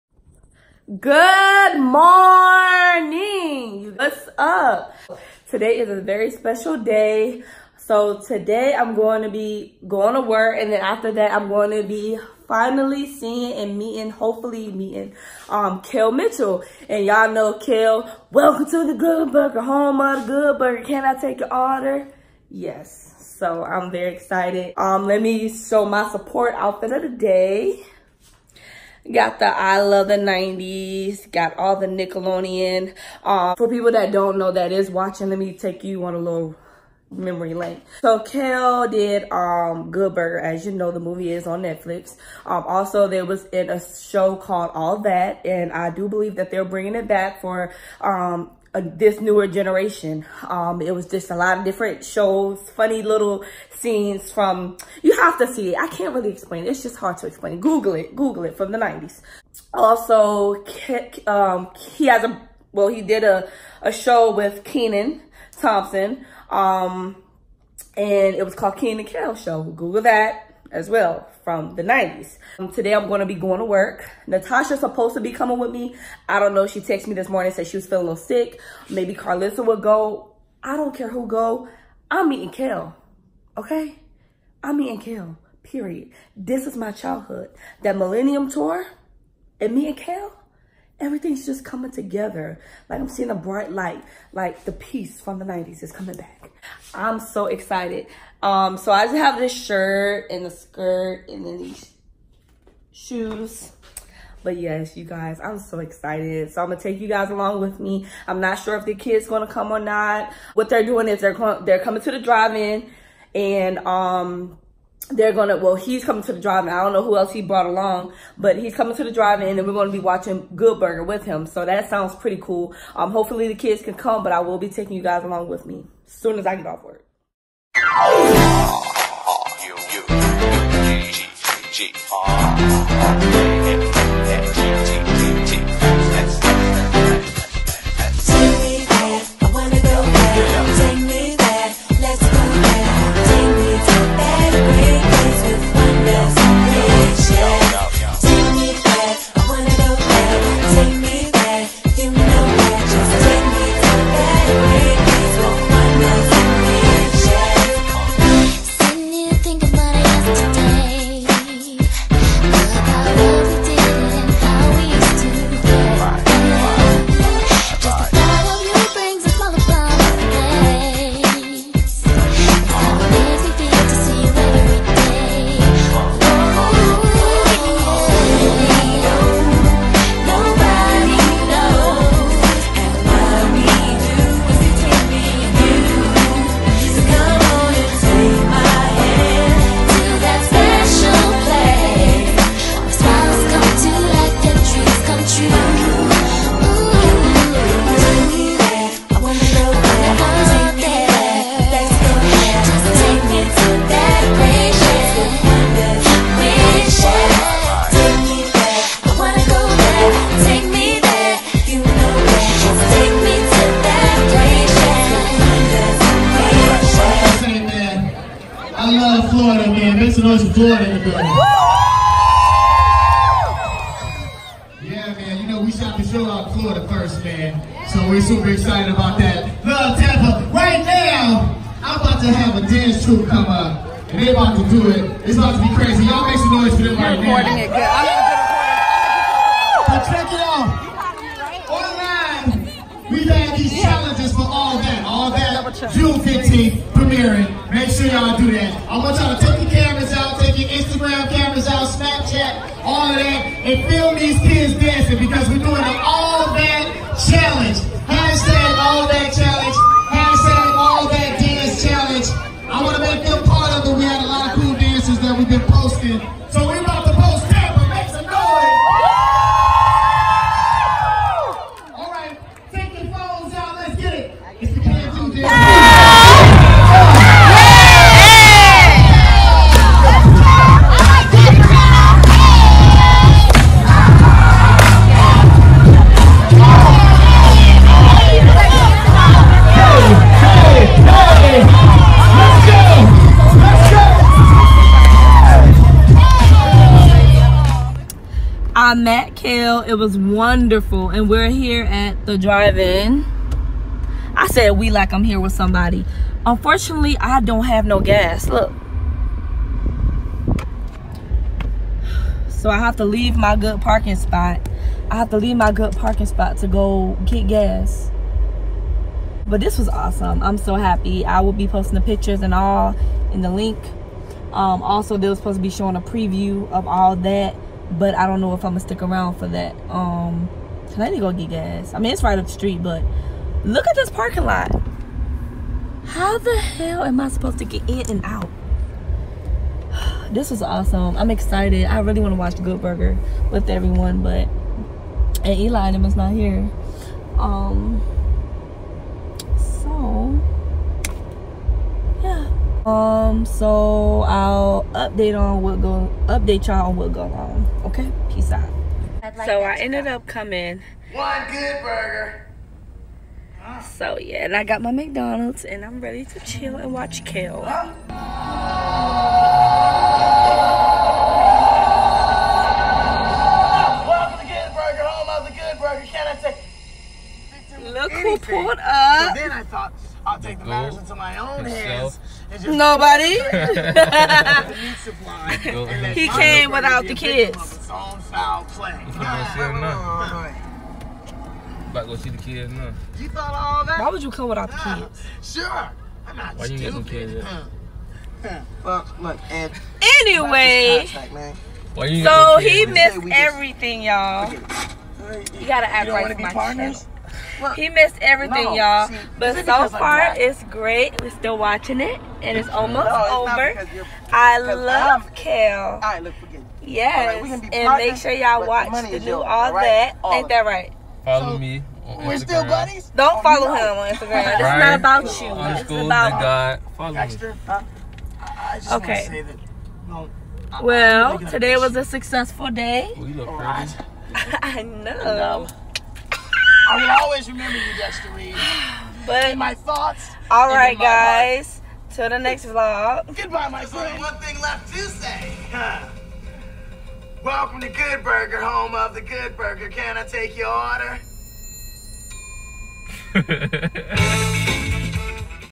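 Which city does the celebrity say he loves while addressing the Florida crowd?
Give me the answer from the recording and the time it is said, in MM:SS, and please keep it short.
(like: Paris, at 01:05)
Tampa, at 03:49.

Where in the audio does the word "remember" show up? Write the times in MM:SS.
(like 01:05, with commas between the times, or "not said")
07:17.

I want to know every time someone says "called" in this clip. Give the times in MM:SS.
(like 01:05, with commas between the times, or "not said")
00:44, 01:08.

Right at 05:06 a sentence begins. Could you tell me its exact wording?
Unfortunately, I don't have no gas.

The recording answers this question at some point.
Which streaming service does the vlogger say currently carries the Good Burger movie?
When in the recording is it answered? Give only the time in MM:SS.
00:41.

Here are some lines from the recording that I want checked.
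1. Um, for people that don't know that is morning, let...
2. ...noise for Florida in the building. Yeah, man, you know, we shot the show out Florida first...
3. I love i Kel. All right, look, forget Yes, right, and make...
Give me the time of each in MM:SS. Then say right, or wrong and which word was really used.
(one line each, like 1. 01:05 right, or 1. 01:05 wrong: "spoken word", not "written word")
1. 00:33 wrong: "watching", not "morning"
2. 03:40 right
3. 06:54 right.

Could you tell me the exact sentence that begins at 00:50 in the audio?
Um, it was just a lot of different shows, funny little scenes from, you have to see it.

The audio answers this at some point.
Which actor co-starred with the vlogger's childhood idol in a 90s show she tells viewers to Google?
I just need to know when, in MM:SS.
01:04.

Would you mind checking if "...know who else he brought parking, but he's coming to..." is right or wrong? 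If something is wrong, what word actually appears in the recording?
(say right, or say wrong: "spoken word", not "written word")
wrong: "along", not "parking".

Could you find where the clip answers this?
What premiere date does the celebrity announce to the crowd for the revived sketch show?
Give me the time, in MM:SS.
04:05.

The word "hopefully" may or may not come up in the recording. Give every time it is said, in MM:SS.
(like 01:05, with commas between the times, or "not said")
00:14, 02:03.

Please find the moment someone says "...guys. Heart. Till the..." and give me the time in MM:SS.
07:20.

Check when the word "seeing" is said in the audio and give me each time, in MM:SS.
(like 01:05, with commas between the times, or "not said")
00:13, 01:33.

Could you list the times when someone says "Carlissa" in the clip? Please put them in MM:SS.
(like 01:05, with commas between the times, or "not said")
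01:19.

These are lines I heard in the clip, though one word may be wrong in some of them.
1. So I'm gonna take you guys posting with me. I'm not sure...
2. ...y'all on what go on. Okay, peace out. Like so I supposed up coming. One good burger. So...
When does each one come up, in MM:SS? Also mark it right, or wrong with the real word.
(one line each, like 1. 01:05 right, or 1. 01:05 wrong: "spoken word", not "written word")
1. 01:46 wrong: "along", not "posting"
2. 05:56 wrong: "ended", not "supposed".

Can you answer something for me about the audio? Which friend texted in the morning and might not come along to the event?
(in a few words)
Natasha.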